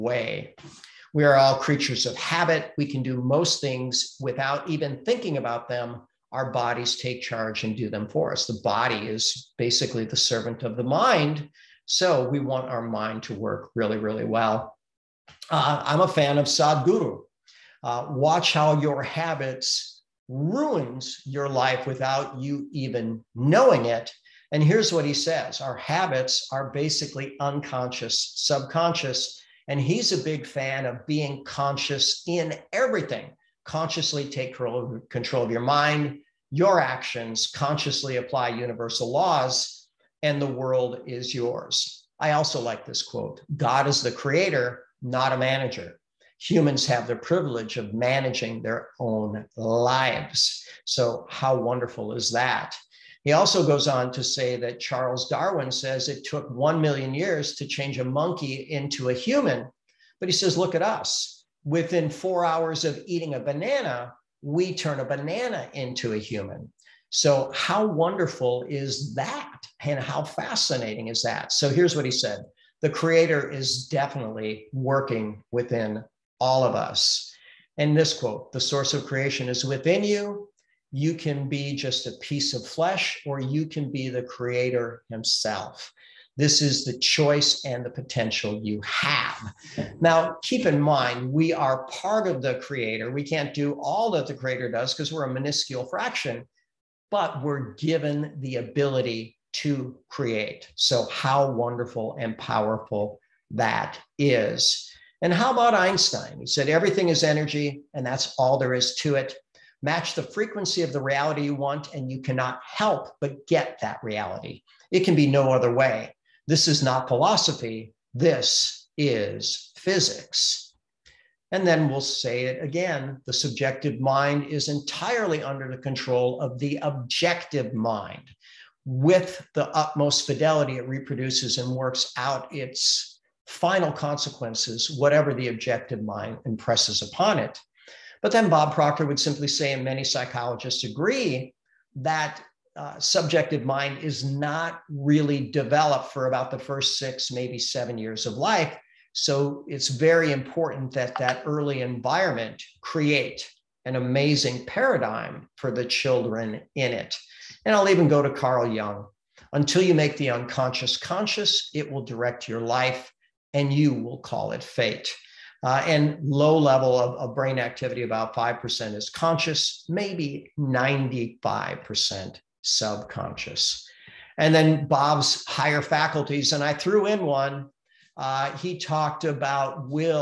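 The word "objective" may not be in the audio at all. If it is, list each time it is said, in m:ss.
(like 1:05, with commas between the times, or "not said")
2:06, 2:15.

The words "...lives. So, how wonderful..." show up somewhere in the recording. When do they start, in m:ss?
0:49.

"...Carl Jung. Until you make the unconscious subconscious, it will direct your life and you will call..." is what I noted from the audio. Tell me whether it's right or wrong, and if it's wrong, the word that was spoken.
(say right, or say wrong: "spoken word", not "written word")
wrong: "conscious", not "subconscious".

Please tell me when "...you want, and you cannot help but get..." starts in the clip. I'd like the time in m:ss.
1:51.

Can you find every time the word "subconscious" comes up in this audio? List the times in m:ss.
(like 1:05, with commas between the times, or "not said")
0:28, 2:52.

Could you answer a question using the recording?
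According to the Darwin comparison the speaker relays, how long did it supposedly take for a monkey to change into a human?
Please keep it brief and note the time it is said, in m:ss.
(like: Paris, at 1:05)
1 million years, at 0:56.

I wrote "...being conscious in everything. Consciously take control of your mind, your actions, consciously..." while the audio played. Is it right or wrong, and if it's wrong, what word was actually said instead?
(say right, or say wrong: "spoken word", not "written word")
right.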